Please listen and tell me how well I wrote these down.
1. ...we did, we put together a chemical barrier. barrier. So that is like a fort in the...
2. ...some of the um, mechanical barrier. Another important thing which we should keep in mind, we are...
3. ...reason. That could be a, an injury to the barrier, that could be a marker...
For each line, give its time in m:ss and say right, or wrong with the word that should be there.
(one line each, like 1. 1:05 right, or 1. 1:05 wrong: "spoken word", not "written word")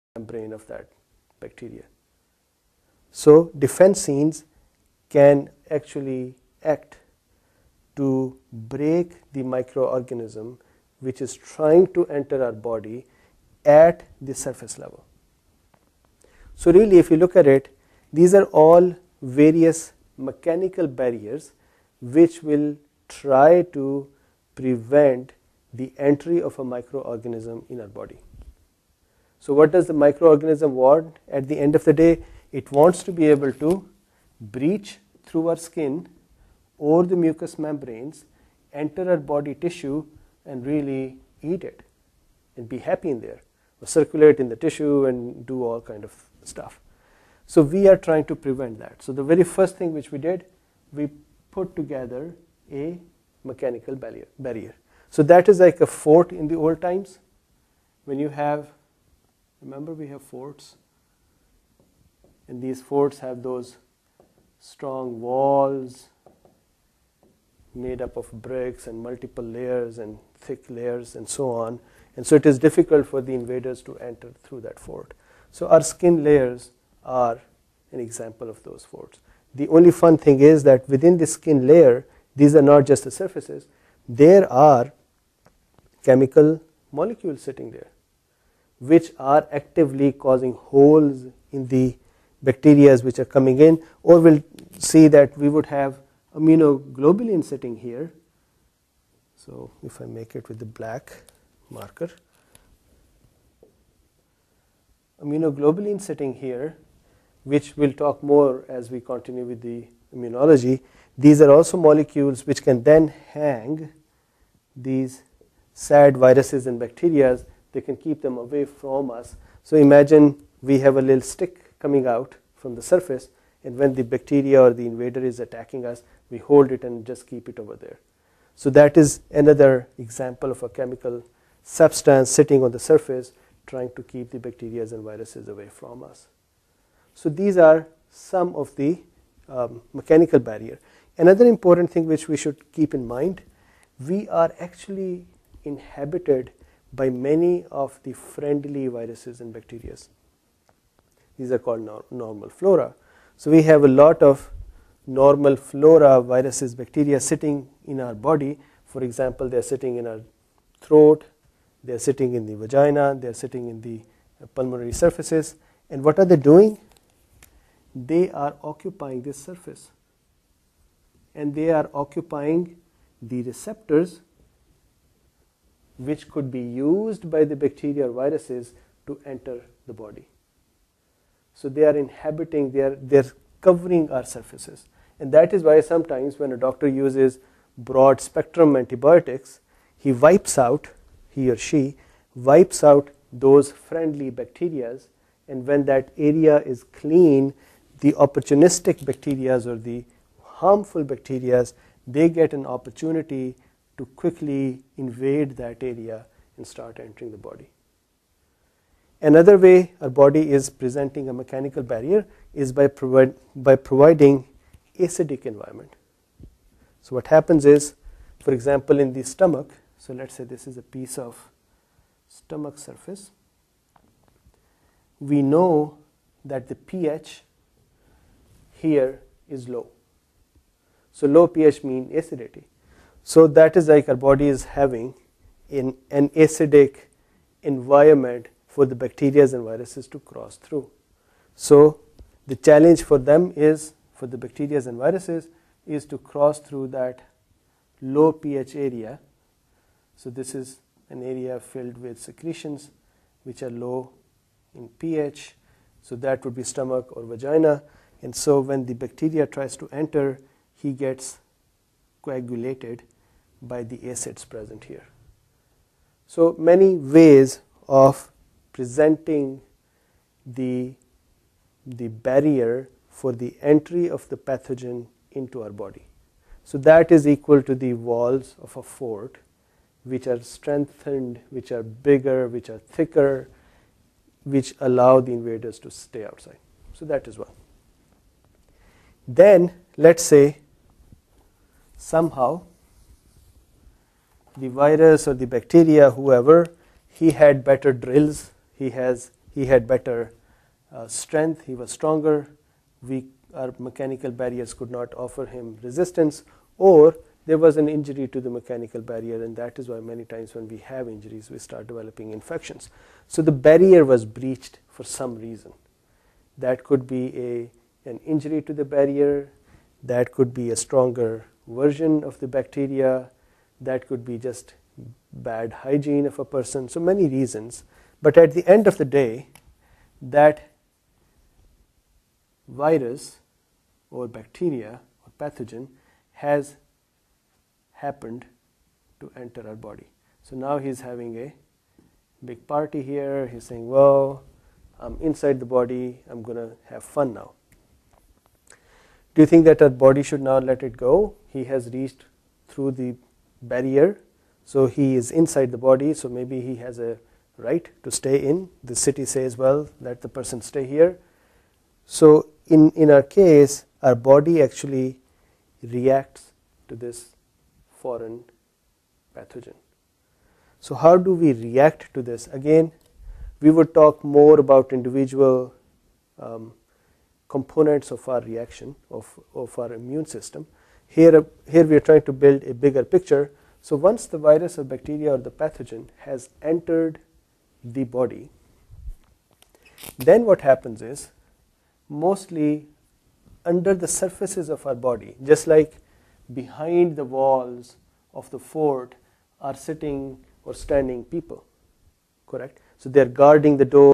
1. 0:50 wrong: "mechanical", not "chemical"
2. 2:18 right
3. 5:15 wrong: "stronger", not "marker".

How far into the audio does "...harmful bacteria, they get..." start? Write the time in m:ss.
3:20.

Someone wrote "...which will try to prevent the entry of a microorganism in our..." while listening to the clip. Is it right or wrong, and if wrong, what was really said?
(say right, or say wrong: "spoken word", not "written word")
right.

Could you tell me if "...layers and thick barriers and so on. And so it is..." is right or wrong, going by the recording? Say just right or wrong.
wrong.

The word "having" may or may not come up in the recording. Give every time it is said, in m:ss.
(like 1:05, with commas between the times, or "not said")
3:54, 5:41.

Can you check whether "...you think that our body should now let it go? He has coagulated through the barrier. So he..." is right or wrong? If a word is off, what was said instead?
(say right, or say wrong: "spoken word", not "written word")
wrong: "reached", not "coagulated".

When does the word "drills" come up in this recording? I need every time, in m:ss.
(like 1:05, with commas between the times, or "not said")
4:57.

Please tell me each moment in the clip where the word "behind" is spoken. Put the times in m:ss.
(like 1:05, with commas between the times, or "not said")
6:36.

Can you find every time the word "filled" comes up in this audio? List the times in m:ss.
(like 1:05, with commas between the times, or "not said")
4:11.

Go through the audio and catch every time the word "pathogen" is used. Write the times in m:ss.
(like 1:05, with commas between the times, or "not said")
4:34, 5:35, 6:09, 6:25.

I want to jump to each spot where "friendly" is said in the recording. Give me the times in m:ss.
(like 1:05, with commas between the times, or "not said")
2:28, 3:13.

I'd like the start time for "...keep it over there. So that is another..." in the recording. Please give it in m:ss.
2:07.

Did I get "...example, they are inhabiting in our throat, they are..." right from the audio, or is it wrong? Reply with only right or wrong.
wrong.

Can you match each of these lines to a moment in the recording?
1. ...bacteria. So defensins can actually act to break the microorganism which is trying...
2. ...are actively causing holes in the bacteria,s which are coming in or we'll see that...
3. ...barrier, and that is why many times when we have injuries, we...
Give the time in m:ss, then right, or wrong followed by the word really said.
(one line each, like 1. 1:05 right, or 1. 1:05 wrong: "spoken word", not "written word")
1. 0:01 right
2. 1:29 right
3. 5:09 right.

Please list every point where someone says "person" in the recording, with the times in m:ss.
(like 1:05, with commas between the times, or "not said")
5:26, 6:00.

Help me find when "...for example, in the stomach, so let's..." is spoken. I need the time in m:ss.
3:38.